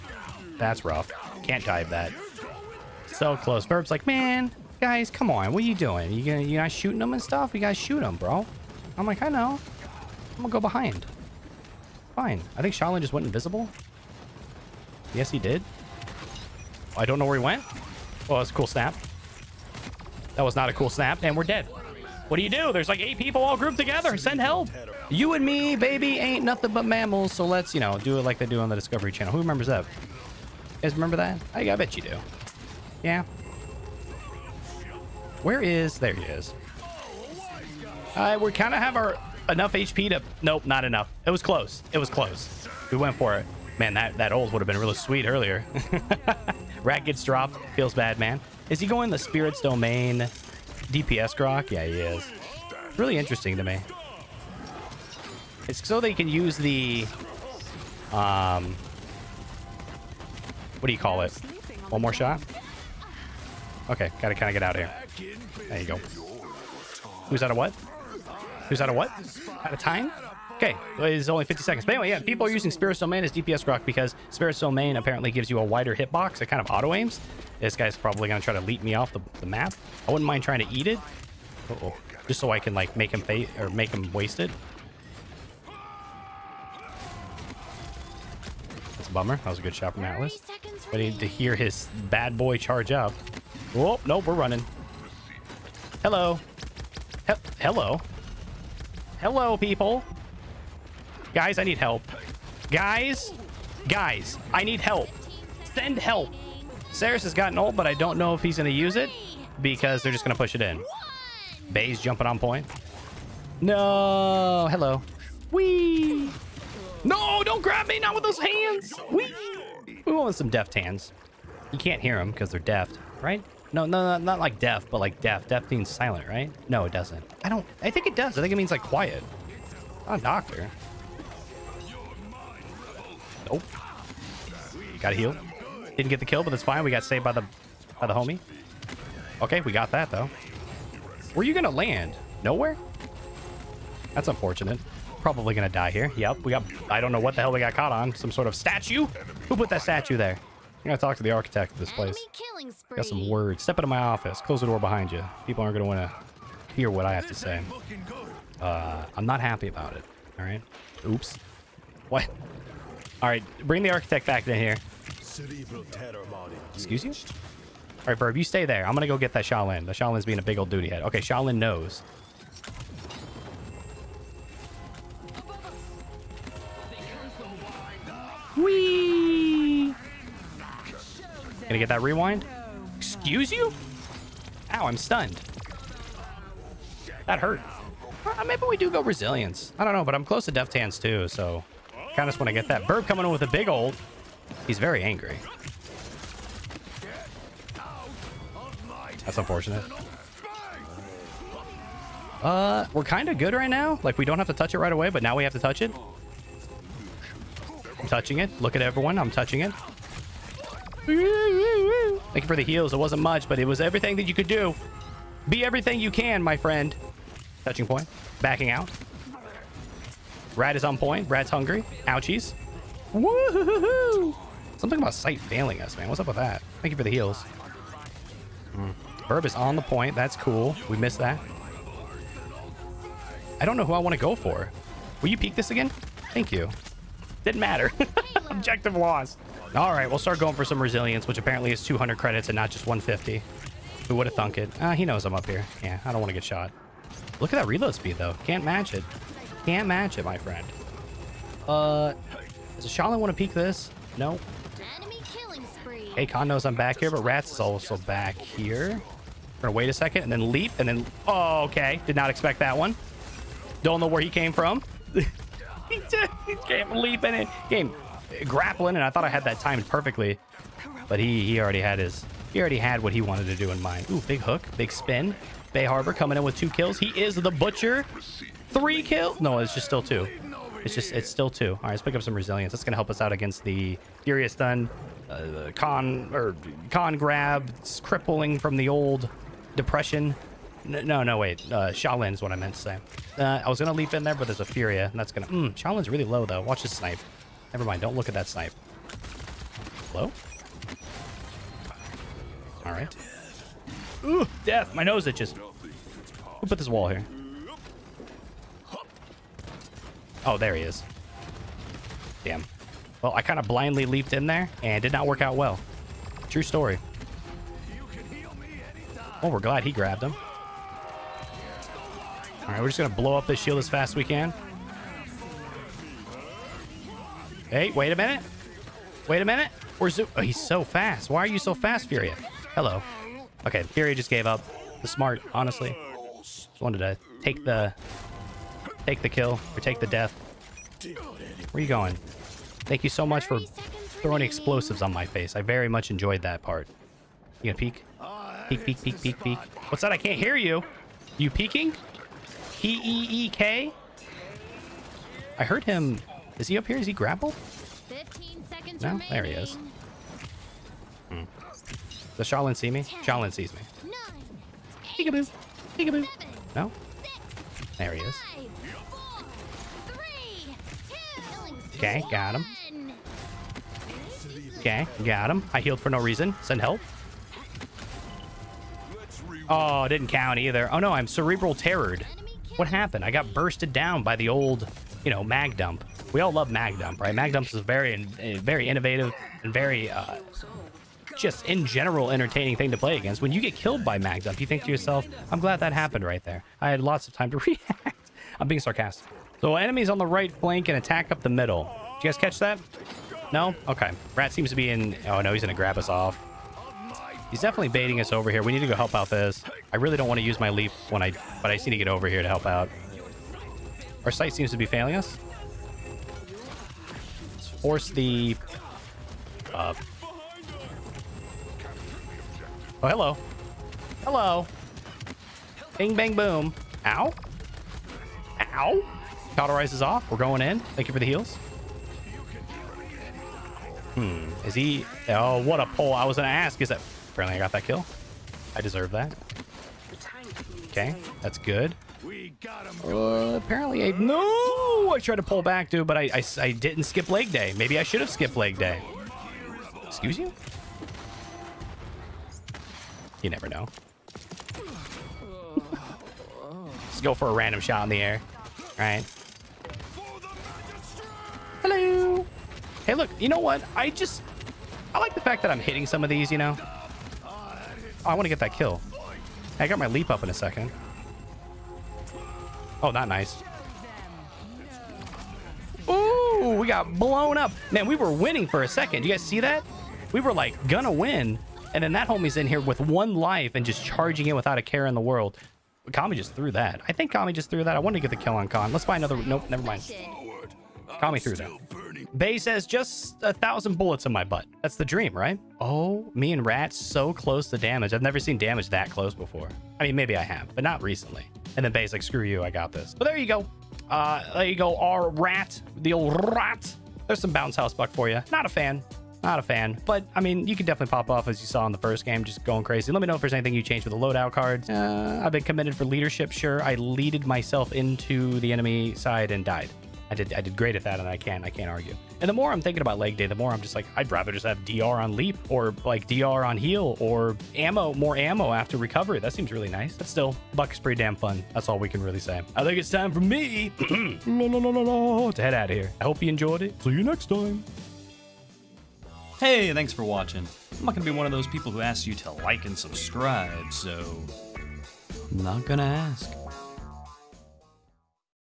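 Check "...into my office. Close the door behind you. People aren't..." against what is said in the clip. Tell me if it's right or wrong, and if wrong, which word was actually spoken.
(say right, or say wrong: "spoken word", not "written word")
right.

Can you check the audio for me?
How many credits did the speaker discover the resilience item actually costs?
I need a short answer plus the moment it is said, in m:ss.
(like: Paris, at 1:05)
200, at 4:01.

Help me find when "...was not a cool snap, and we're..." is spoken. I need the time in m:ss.
0:20.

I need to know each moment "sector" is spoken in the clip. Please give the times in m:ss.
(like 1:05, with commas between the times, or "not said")
not said.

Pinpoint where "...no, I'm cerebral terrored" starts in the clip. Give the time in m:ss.
6:20.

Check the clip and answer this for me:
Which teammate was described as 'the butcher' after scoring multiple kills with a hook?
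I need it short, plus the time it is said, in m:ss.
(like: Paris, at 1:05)
Bay Harbor, at 4:35.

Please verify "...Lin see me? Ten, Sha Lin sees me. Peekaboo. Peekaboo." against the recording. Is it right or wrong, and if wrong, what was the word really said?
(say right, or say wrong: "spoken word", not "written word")
right.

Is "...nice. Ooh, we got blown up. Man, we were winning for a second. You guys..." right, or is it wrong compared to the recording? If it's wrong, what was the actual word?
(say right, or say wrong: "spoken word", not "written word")
right.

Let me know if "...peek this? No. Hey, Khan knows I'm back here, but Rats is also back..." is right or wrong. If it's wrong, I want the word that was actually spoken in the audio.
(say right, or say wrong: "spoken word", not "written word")
right.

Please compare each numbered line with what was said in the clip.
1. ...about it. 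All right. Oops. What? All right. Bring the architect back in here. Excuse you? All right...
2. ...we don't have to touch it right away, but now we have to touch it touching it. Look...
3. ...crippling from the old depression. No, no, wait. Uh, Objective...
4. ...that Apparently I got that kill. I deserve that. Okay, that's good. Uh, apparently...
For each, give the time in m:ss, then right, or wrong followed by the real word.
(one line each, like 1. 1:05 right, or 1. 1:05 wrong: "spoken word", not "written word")
1. 2:39 right
2. 3:24 right
3. 4:48 wrong: "Sha", not "Objective"
4. 7:16 right.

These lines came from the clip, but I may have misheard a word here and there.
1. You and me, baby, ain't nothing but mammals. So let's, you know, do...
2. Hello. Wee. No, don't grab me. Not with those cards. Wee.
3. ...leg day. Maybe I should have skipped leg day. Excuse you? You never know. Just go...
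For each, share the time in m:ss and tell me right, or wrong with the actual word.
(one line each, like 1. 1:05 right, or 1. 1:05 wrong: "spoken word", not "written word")
1. 0:25 right
2. 1:54 wrong: "hands", not "cards"
3. 7:27 right.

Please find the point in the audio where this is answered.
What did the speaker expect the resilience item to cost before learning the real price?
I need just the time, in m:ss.
4:02.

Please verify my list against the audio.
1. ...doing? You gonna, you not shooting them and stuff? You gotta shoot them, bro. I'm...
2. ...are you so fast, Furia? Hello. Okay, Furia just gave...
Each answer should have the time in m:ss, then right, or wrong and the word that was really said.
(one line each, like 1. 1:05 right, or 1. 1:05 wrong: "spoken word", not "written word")
1. 0:05 right
2. 5:31 right.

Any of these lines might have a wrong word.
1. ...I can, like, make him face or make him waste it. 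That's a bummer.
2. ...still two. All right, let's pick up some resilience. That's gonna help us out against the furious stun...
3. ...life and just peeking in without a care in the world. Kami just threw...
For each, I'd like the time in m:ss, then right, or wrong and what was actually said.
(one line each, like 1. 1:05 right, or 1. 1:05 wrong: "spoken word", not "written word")
1. 1:22 right
2. 4:41 right
3. 8:03 wrong: "charging", not "peeking".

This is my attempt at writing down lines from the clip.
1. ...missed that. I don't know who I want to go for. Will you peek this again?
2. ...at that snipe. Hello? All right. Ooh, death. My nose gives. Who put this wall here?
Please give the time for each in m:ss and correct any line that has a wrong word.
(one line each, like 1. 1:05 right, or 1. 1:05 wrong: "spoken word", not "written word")
1. 3:50 right
2. 4:58 wrong: "itches", not "gives".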